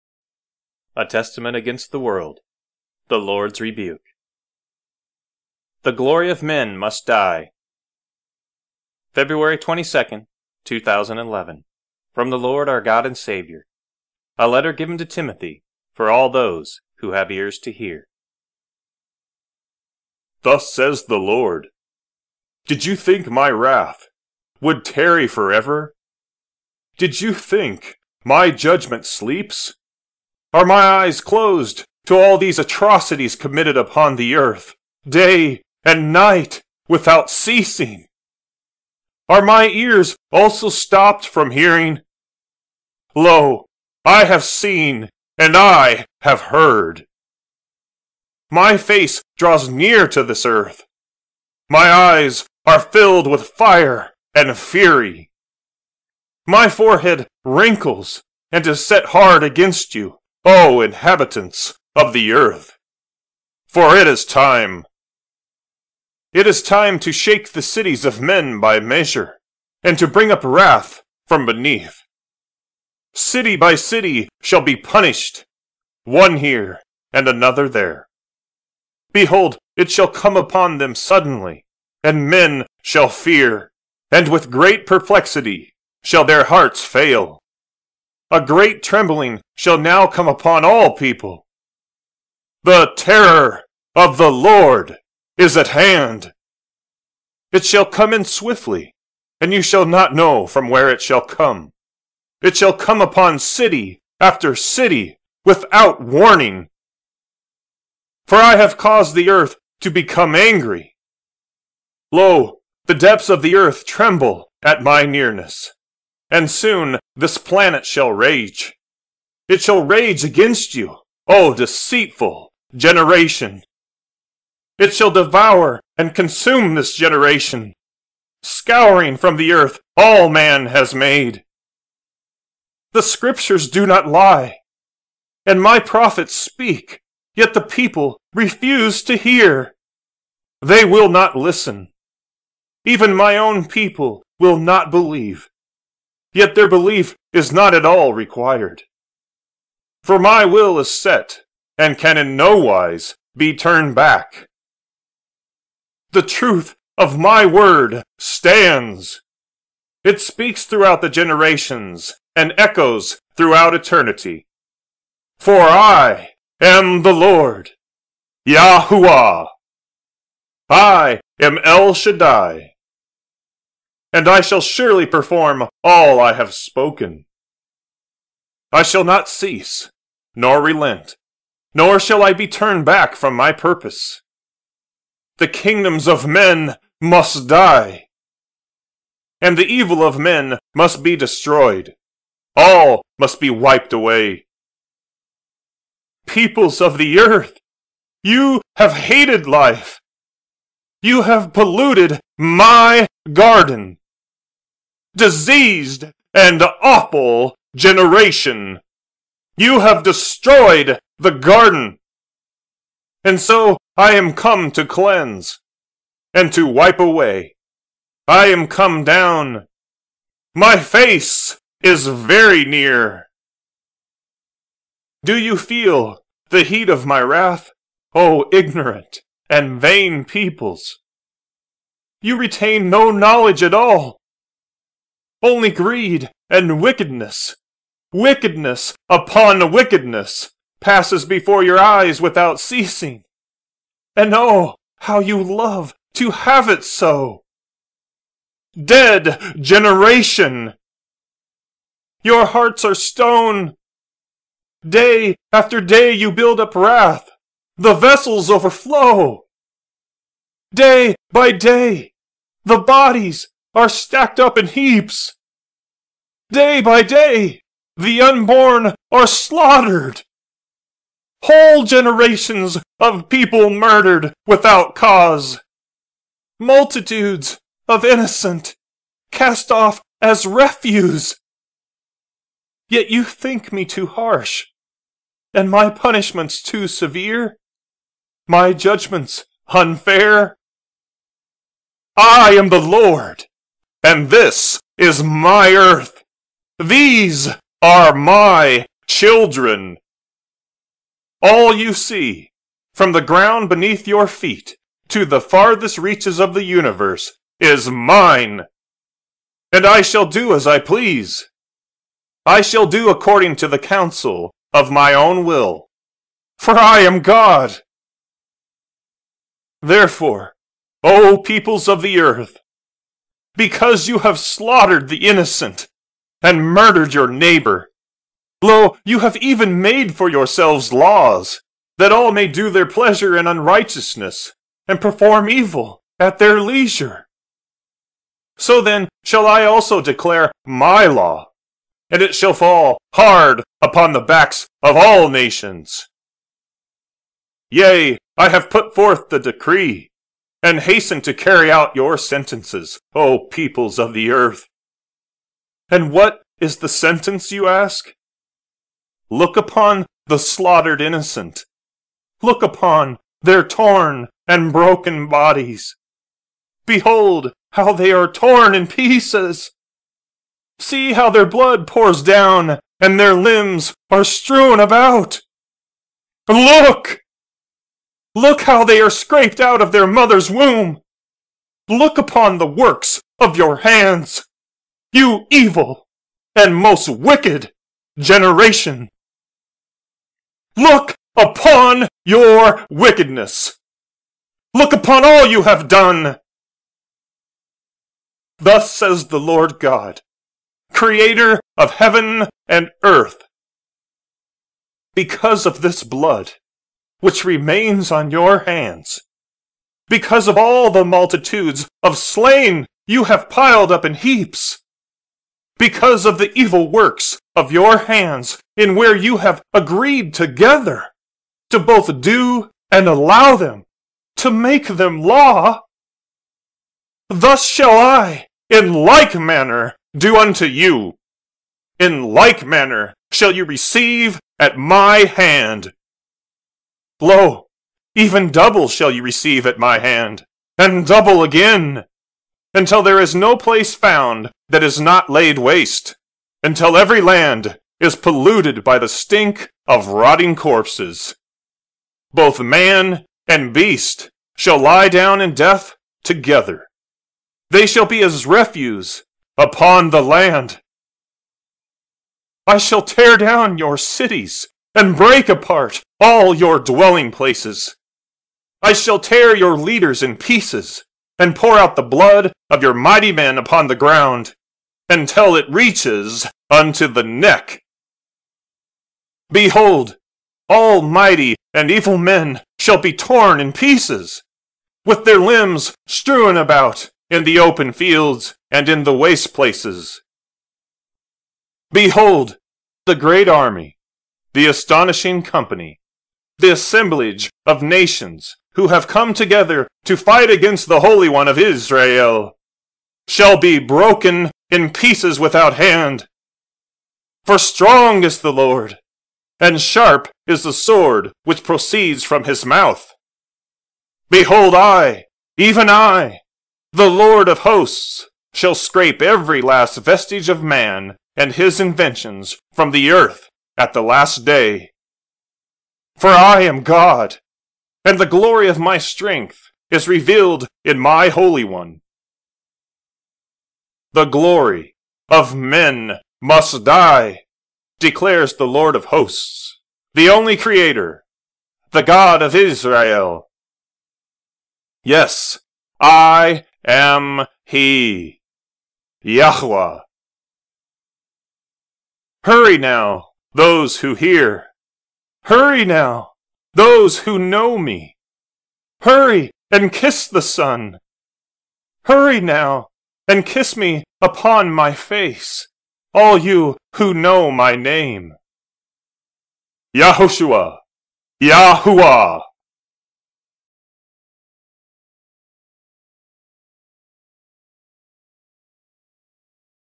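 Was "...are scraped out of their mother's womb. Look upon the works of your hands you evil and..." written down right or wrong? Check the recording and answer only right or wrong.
right.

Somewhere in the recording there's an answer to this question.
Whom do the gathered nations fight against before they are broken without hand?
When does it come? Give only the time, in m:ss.
8:20.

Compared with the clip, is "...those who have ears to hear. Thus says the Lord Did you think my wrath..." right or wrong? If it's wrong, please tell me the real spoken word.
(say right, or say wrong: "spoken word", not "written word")
right.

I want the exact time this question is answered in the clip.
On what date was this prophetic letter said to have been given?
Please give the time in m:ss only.
0:09.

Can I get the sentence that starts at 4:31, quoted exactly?
Whole generations of people murdered without cause.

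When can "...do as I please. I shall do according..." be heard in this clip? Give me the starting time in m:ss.
5:10.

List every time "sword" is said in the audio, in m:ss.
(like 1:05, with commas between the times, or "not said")
8:30.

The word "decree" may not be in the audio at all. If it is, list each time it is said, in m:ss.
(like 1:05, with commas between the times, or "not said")
5:49.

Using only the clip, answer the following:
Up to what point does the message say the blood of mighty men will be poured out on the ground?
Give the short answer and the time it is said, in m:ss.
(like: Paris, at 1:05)
unto the neck, at 7:56.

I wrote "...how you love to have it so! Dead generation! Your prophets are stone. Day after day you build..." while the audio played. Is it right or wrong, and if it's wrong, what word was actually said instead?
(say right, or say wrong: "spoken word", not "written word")
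wrong: "hearts", not "prophets".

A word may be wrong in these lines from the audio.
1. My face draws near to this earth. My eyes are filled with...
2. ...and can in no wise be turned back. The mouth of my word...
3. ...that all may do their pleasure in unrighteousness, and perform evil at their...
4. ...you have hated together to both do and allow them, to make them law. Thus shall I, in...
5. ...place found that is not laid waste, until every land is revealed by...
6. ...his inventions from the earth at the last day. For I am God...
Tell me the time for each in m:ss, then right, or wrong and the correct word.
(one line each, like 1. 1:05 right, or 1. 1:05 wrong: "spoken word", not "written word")
1. 0:48 right
2. 2:31 wrong: "truth", not "mouth"
3. 5:31 right
4. 6:59 wrong: "agreed", not "hated"
5. 7:23 wrong: "polluted", not "revealed"
6. 8:41 right.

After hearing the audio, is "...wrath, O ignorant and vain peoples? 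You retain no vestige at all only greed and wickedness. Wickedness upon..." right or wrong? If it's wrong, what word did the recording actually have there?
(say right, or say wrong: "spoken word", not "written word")
wrong: "knowledge", not "vestige".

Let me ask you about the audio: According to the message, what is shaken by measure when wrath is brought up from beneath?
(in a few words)
the cities of men.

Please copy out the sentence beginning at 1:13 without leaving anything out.
City by city shall be punished, one here and another there.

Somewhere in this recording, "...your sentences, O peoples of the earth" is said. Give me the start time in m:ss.
5:51.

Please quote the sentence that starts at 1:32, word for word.
The terror of the Lord is at hand.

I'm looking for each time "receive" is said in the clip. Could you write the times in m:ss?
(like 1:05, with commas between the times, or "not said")
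7:13, 7:19.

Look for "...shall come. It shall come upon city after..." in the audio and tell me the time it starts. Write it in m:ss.
1:41.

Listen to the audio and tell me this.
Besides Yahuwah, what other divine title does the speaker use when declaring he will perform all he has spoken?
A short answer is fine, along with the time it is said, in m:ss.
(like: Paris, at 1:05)
El Shaddai, at 2:51.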